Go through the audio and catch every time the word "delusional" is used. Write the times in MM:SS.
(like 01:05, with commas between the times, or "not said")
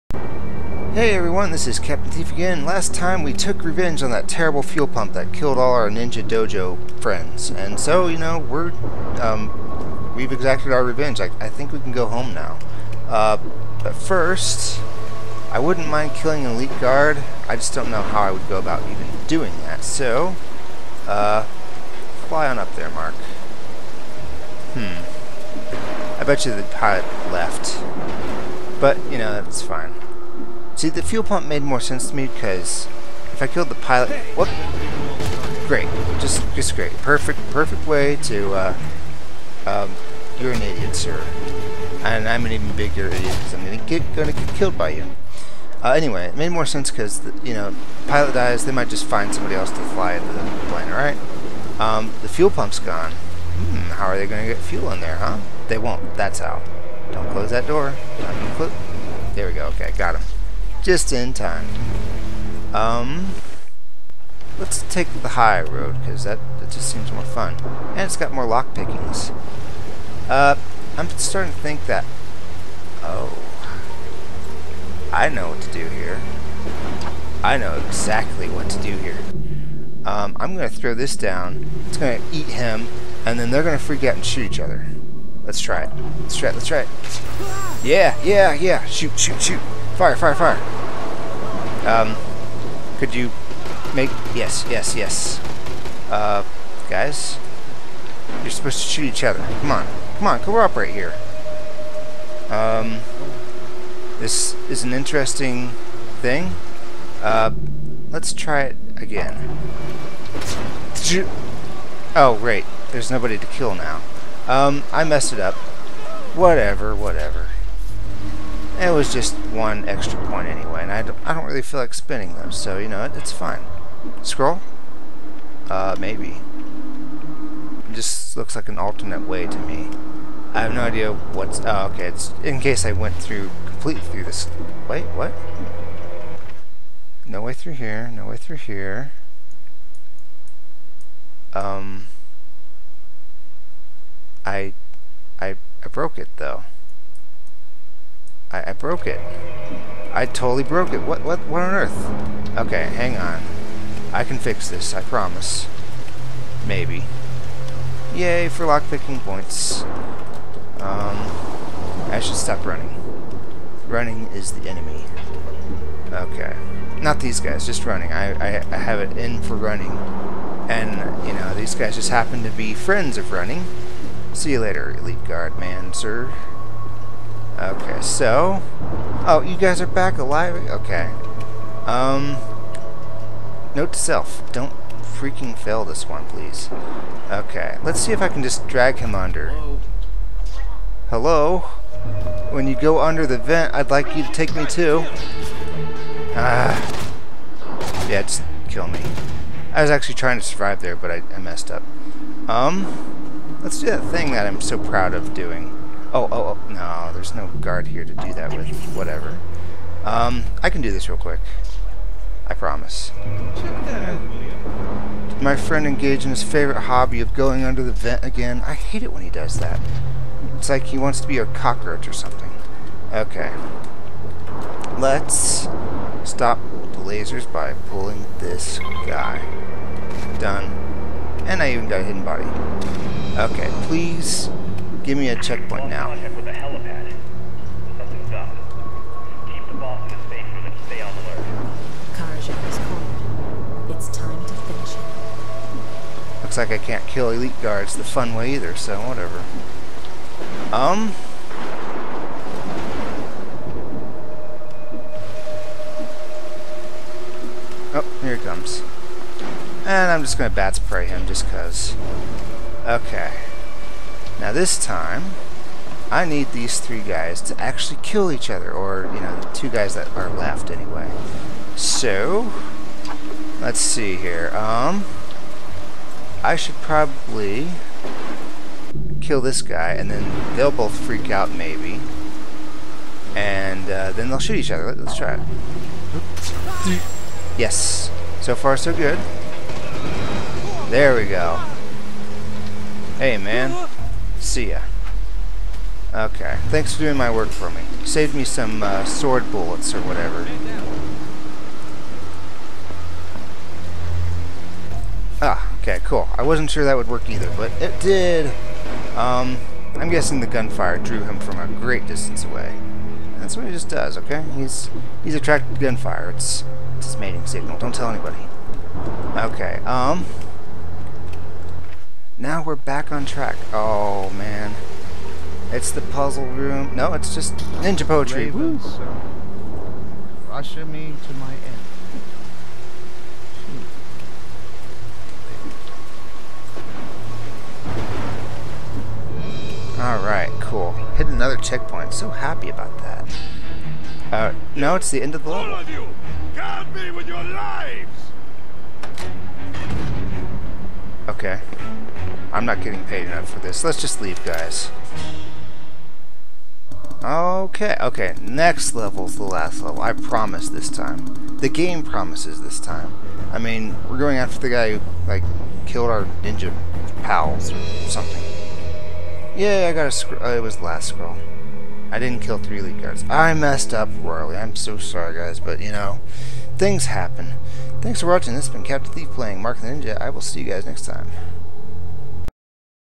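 not said.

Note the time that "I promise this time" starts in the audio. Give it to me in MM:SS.
06:00.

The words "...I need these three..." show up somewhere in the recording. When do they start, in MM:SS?
04:26.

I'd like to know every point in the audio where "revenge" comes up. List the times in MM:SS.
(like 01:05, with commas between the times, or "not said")
00:03, 00:10.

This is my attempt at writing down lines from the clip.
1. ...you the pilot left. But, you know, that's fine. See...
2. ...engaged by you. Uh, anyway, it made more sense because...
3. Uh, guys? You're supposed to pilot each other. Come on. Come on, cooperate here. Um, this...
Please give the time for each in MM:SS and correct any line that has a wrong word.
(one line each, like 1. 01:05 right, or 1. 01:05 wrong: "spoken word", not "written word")
1. 00:26 right
2. 00:44 wrong: "killed", not "engaged"
3. 01:36 wrong: "shoot", not "pilot".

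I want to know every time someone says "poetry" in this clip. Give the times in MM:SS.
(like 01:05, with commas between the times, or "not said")
05:28.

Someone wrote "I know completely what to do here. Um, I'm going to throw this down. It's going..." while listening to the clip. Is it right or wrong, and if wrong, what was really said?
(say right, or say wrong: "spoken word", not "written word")
wrong: "exactly", not "completely".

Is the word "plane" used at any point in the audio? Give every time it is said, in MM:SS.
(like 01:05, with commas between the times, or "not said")
00:50.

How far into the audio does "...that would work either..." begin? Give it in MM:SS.
05:06.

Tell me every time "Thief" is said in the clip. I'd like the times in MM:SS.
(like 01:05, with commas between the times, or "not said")
00:02, 06:19.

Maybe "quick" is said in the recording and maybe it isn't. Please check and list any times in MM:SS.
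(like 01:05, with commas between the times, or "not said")
03:31.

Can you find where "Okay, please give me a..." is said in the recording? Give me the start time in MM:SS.
03:53.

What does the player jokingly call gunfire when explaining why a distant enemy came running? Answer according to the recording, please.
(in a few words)
his mating signal.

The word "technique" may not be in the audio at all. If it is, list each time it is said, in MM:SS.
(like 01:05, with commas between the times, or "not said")
not said.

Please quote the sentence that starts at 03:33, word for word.
Did my friend engaged in his favorite hobby of going under the vent again?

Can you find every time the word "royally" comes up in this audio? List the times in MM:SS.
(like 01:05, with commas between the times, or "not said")
06:14.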